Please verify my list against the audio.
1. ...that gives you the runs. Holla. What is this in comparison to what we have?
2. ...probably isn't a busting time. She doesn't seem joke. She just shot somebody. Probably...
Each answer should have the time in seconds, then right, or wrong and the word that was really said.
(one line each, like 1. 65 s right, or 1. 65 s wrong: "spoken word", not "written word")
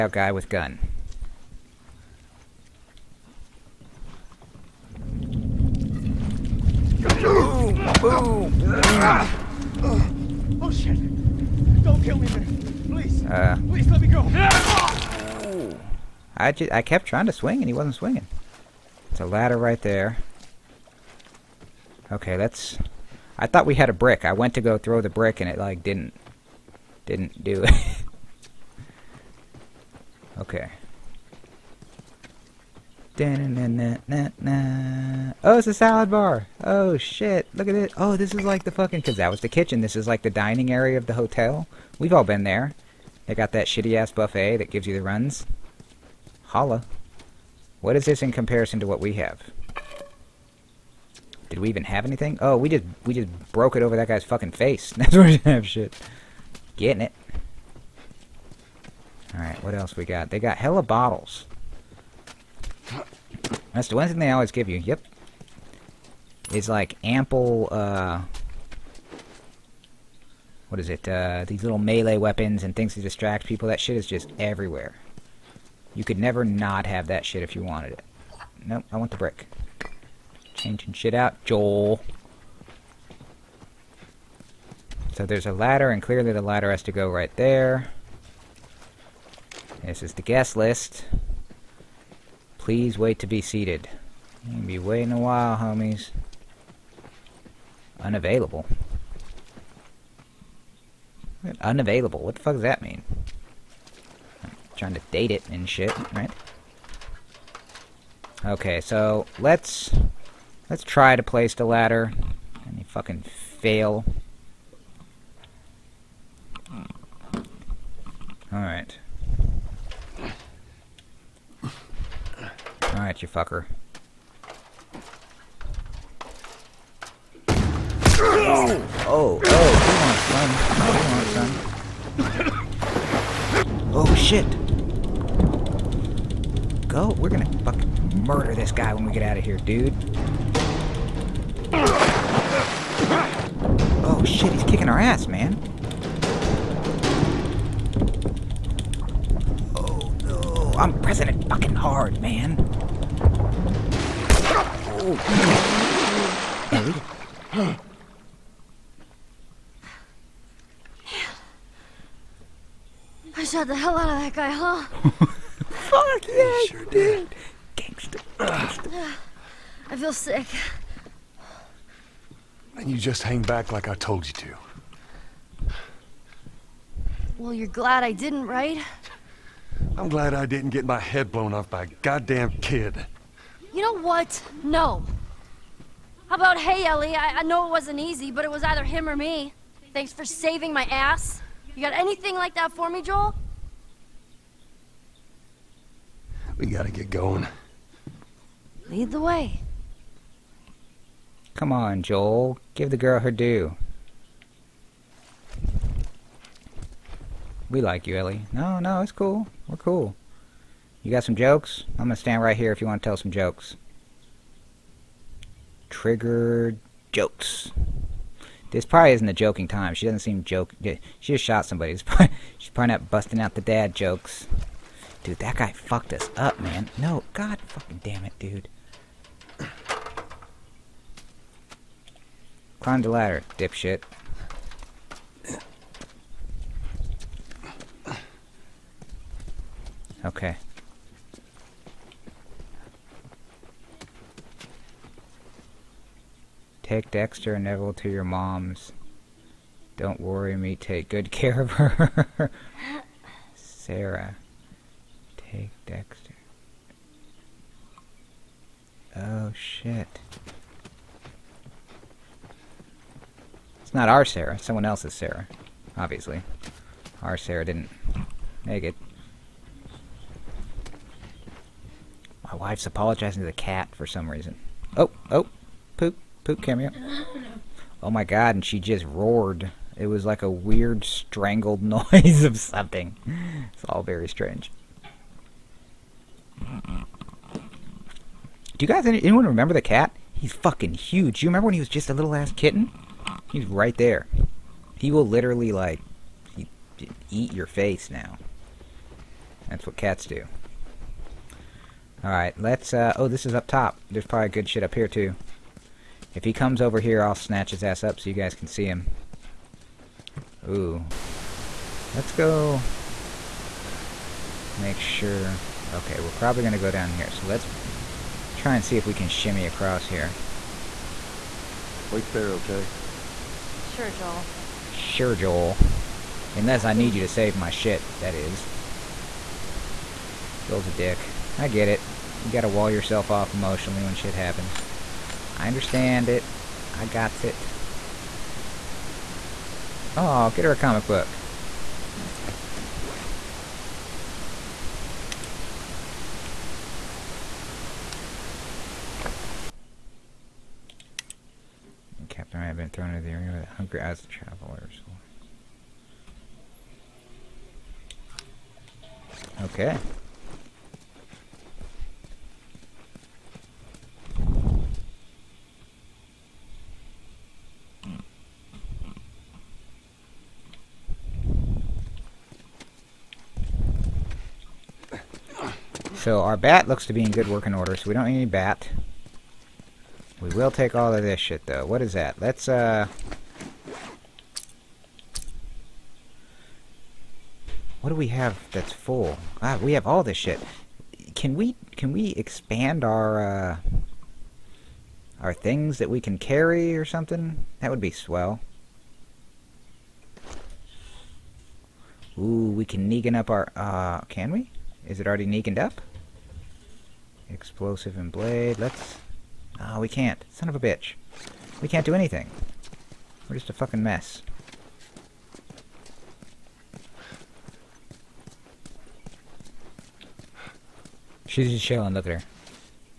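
1. 44 s right
2. 218 s wrong: "joking", not "busting".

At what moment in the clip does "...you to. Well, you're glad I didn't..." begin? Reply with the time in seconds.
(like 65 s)
174 s.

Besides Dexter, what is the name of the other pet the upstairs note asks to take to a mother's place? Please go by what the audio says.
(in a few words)
Neville.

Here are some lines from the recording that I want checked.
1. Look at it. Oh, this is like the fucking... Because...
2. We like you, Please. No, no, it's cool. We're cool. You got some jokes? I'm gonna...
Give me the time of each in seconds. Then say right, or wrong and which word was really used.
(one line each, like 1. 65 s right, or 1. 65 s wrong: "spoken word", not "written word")
1. 37 s right
2. 207 s wrong: "Ellie", not "Please".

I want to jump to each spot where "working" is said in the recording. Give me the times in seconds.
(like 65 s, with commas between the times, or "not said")
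377 s.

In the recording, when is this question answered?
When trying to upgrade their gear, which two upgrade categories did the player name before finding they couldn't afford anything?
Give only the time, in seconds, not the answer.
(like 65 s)
407 s.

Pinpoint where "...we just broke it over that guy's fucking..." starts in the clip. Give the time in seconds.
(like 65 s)
53 s.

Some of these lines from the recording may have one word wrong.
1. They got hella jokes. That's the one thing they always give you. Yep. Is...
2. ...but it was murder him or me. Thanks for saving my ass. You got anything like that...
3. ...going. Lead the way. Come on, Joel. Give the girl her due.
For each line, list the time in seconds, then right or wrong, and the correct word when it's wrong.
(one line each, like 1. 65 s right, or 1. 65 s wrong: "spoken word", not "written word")
1. 60 s wrong: "bottles", not "jokes"
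2. 188 s wrong: "either", not "murder"
3. 197 s right.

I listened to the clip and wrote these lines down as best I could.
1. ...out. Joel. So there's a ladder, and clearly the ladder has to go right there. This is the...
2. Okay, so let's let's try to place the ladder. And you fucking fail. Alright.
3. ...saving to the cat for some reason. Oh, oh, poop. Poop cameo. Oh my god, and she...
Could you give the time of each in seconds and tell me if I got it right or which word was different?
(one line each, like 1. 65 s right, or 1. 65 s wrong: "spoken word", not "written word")
1. 81 s right
2. 108 s right
3. 272 s wrong: "apologizing", not "saving".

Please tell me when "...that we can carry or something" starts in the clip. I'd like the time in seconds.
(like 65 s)
395 s.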